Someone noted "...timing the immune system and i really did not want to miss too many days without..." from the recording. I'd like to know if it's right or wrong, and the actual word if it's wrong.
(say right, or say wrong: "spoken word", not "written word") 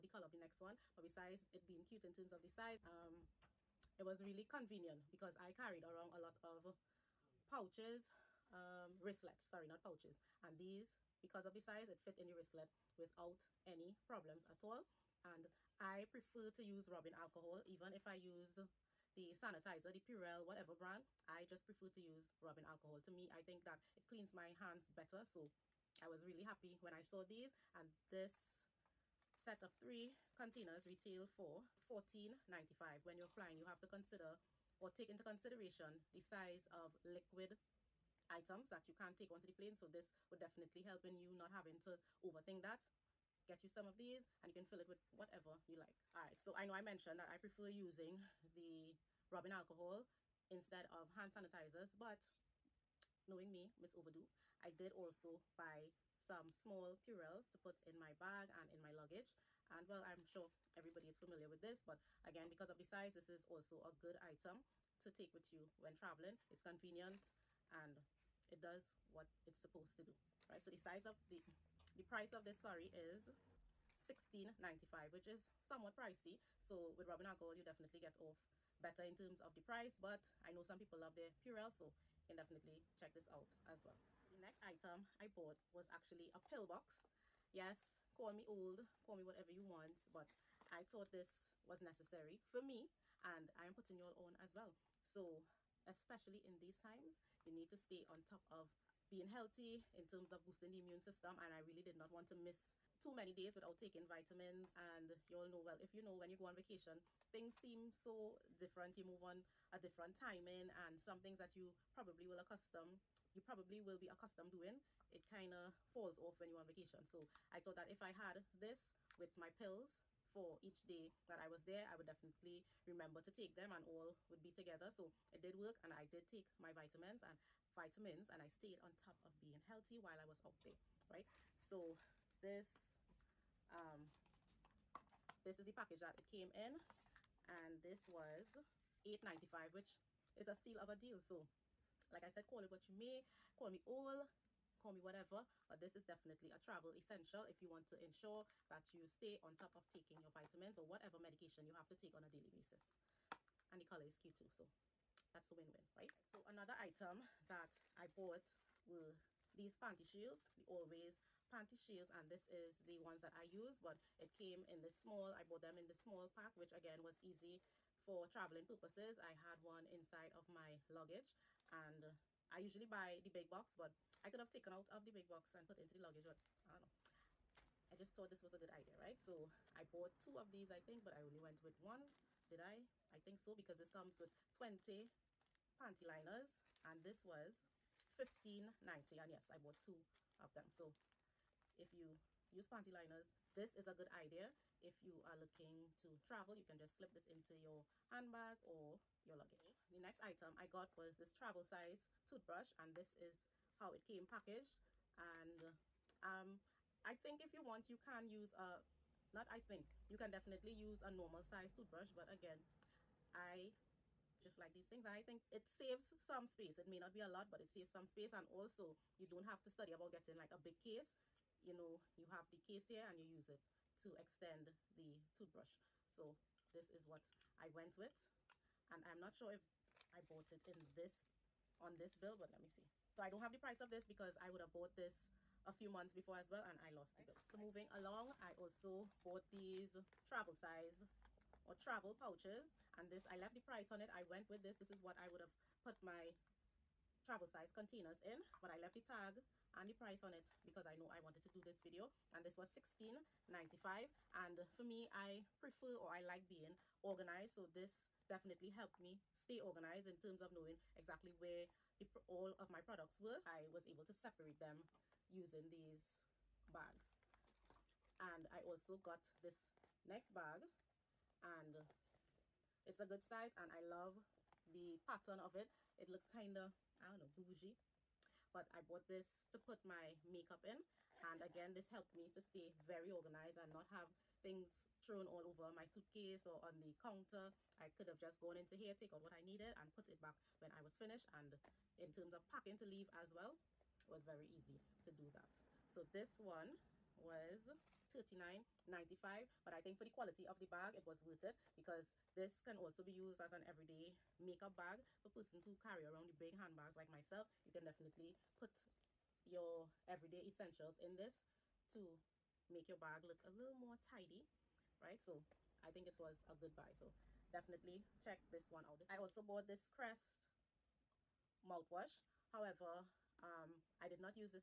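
wrong: "boosting", not "timing".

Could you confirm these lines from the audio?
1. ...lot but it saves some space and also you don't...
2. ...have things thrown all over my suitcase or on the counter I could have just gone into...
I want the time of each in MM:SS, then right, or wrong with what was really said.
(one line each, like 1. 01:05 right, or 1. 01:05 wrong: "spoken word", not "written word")
1. 03:37 right
2. 04:43 right.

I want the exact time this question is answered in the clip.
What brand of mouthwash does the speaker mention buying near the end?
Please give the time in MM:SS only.
05:19.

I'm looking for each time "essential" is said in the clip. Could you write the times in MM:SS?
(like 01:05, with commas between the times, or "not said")
02:26, 05:10.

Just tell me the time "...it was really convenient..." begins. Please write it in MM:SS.
00:03.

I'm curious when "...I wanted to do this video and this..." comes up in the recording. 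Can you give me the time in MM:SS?
04:11.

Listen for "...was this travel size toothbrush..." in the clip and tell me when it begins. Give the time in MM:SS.
03:20.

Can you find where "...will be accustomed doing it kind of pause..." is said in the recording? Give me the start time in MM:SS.
01:53.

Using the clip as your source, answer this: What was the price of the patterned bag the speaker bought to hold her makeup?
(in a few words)
$39.95.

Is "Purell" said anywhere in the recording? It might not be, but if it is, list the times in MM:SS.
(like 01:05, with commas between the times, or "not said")
00:20, 00:57, 01:21.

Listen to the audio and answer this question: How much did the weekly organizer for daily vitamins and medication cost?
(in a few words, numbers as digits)
$8.95.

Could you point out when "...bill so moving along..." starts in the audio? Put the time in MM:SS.
03:57.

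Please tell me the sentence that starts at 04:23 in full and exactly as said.
I was able to separate them using these bags.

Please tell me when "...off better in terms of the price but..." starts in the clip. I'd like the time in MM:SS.
01:18.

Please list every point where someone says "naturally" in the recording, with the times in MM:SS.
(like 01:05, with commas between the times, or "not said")
not said.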